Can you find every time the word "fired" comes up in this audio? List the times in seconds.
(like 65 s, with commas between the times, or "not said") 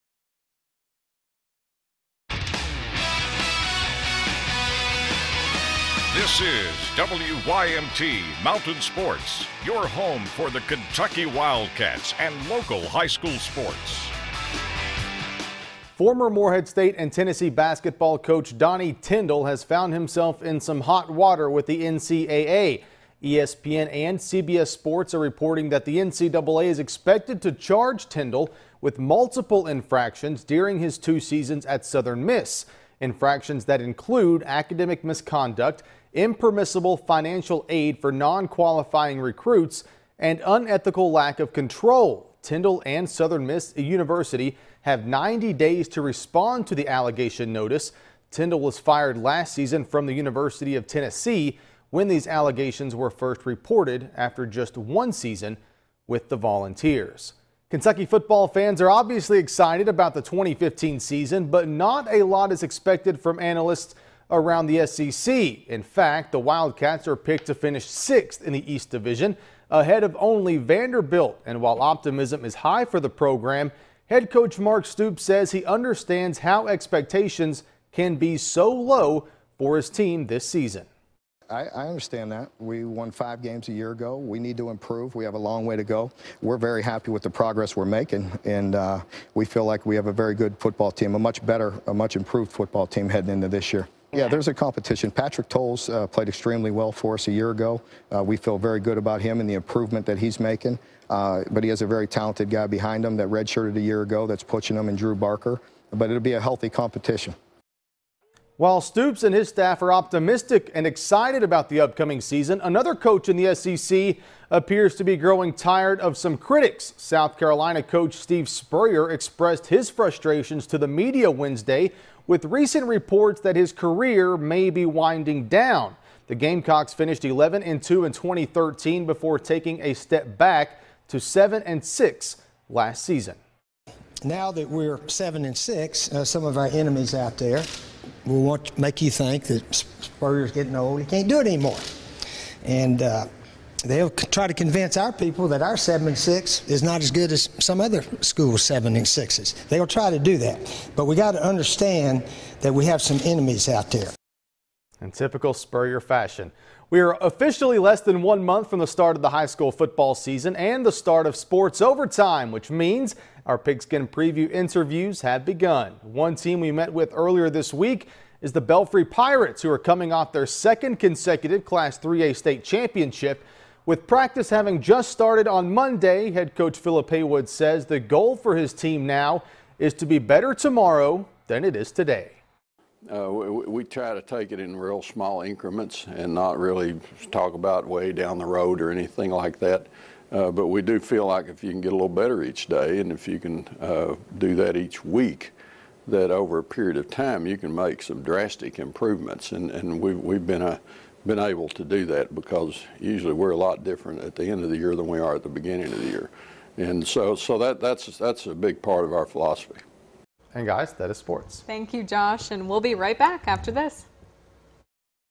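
48 s.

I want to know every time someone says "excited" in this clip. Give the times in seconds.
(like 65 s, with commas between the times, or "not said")
59 s, 110 s.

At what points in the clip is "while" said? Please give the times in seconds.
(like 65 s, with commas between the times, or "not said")
71 s, 108 s.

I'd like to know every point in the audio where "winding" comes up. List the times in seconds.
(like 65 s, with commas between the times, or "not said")
124 s.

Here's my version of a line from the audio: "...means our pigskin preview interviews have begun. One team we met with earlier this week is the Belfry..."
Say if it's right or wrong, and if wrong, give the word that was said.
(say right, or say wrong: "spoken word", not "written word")
right.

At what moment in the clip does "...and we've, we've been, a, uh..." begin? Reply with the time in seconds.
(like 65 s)
199 s.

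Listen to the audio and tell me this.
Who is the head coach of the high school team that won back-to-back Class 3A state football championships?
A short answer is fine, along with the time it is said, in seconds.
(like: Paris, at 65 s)
Philip Haywood, at 176 s.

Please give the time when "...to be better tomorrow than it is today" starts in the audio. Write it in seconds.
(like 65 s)
179 s.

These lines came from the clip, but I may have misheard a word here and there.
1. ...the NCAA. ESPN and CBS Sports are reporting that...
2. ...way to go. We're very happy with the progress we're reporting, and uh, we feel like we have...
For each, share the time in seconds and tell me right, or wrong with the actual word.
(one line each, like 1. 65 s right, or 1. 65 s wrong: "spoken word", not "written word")
1. 21 s right
2. 85 s wrong: "making", not "reporting".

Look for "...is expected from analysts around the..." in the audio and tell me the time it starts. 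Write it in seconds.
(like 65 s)
62 s.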